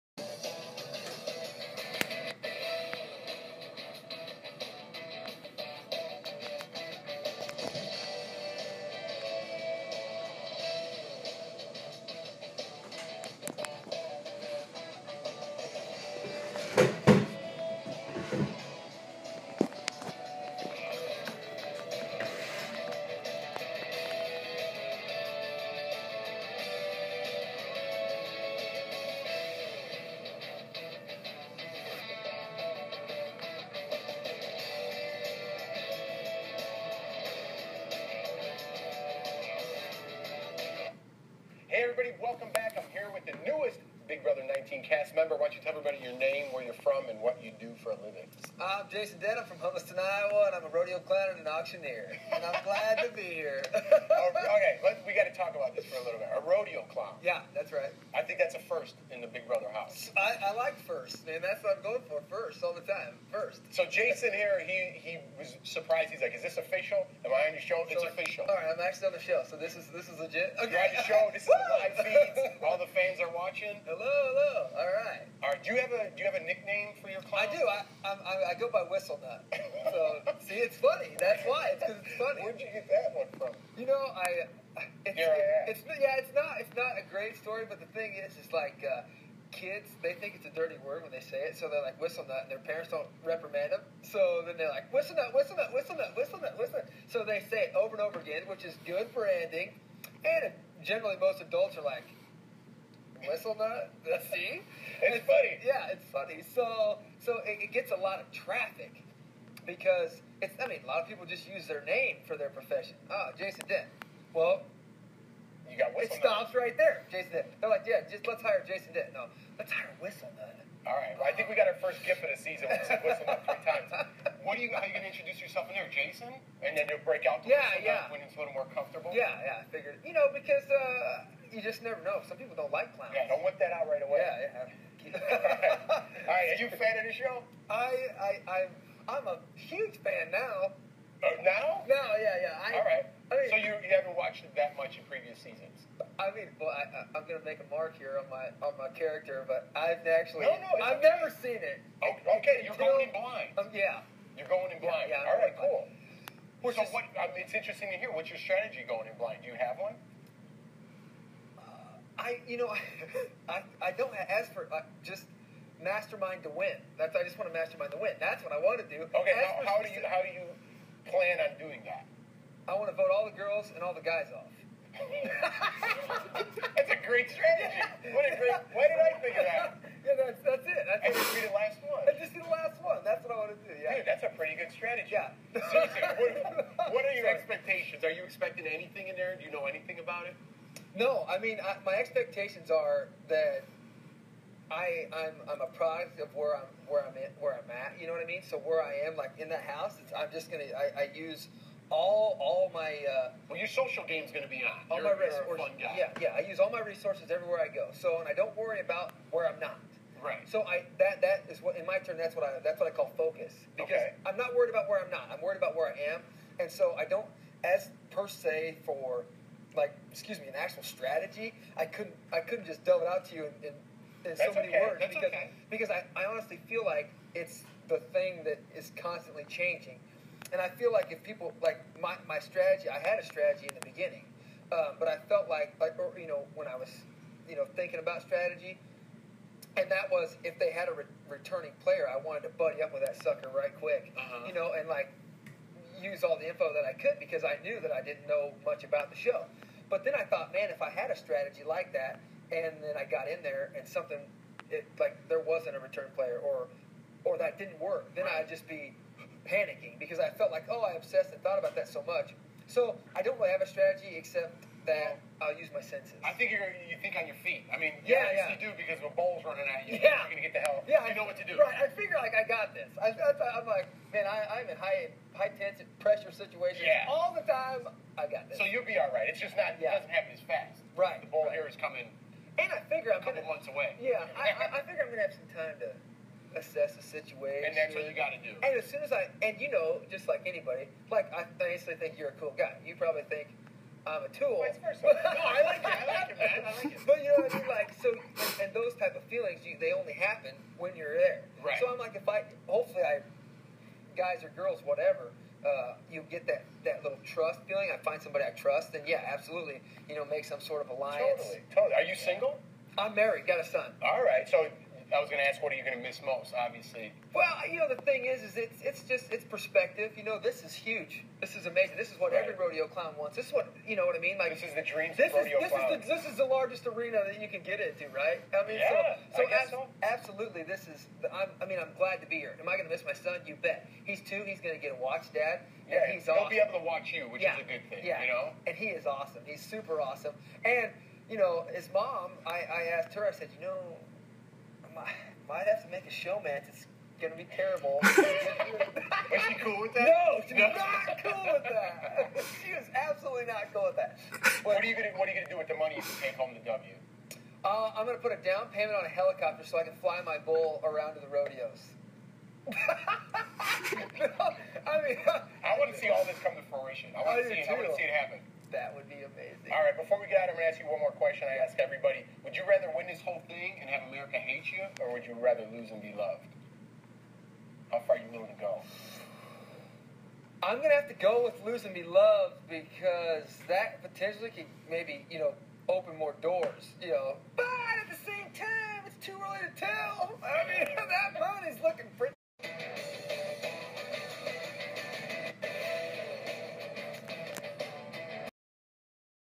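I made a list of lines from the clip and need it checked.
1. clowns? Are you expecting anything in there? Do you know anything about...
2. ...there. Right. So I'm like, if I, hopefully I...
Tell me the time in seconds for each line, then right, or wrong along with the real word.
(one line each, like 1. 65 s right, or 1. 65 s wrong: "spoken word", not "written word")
1. 187 s wrong: "expectations", not "clowns"
2. 301 s right.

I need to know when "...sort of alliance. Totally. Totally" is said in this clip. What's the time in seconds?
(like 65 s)
310 s.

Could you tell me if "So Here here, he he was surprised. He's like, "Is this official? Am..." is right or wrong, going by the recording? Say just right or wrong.
wrong.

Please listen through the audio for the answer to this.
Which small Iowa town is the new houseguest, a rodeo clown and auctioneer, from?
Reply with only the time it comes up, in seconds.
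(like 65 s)
49 s.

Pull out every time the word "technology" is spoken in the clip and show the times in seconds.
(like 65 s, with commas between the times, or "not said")
not said.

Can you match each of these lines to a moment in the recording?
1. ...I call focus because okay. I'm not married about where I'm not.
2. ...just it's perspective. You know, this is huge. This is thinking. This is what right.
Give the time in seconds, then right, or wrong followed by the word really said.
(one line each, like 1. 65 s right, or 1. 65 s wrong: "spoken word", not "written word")
1. 212 s wrong: "worried", not "married"
2. 319 s wrong: "amazing", not "thinking".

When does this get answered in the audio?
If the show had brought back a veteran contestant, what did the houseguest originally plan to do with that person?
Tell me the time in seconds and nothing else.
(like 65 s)
242 s.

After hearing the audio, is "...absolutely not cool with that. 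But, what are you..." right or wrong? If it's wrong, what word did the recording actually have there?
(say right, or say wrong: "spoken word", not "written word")
right.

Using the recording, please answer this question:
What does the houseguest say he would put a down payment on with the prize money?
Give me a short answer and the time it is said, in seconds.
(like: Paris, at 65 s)
a helicopter, at 359 s.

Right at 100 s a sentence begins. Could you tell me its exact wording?
And generally, most adults are like, whistle nut.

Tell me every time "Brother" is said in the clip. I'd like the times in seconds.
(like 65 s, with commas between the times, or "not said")
44 s, 59 s.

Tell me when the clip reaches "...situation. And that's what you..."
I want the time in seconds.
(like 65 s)
287 s.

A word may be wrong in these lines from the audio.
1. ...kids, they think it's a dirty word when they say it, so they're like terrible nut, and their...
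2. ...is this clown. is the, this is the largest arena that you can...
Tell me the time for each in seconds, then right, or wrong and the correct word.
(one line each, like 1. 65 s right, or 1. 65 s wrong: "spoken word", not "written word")
1. 89 s wrong: "whistle", not "terrible"
2. 325 s right.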